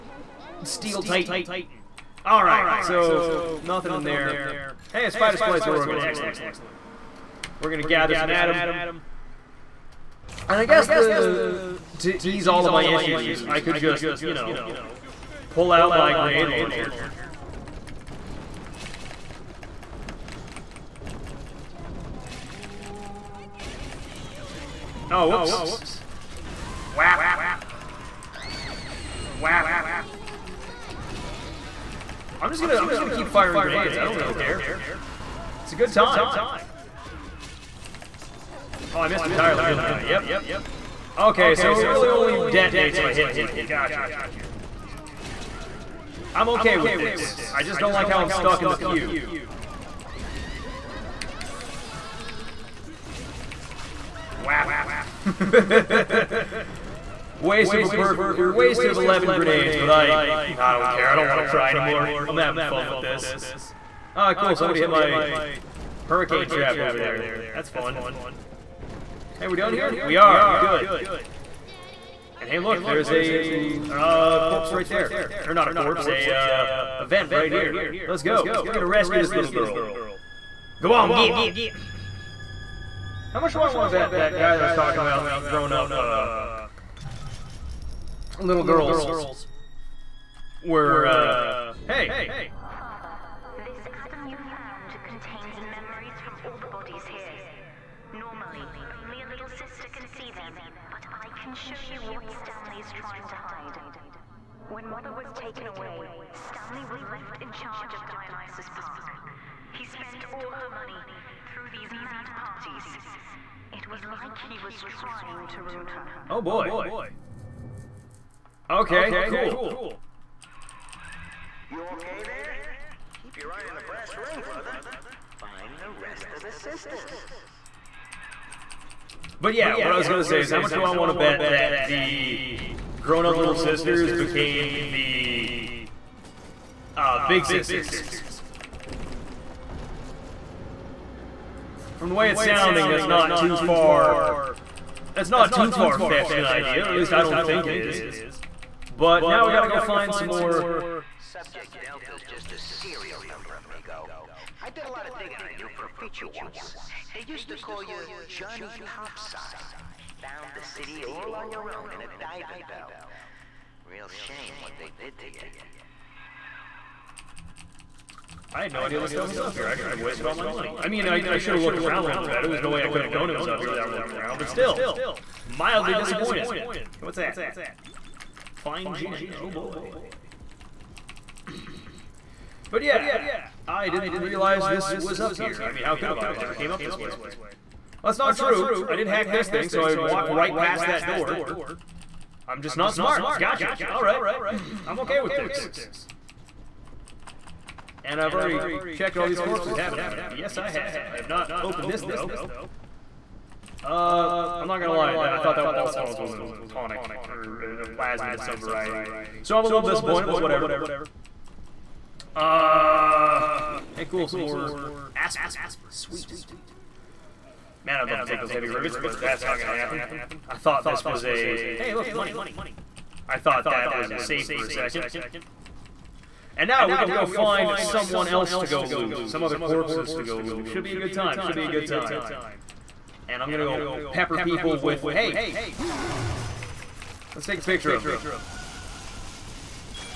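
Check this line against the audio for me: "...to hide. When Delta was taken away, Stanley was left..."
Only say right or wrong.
wrong.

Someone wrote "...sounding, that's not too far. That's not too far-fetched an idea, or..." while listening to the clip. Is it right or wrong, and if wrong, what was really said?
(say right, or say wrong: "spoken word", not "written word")
right.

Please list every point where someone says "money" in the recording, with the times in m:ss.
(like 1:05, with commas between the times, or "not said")
1:50, 2:50, 3:42.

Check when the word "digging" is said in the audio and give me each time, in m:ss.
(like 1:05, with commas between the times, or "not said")
2:35.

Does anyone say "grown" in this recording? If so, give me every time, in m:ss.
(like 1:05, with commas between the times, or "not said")
1:25, 2:12.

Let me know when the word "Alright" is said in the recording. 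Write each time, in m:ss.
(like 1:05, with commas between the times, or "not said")
0:02, 3:13.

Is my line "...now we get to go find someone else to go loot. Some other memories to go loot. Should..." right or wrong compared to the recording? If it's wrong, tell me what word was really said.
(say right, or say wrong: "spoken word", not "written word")
wrong: "corpses", not "memories".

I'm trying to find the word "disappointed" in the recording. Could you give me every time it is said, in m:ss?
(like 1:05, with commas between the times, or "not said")
2:55, 3:29.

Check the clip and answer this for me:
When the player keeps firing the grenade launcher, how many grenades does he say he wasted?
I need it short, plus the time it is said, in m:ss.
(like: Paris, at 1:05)
11, at 0:58.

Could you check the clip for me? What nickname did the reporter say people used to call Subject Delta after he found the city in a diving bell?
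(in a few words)
Johnny Topside.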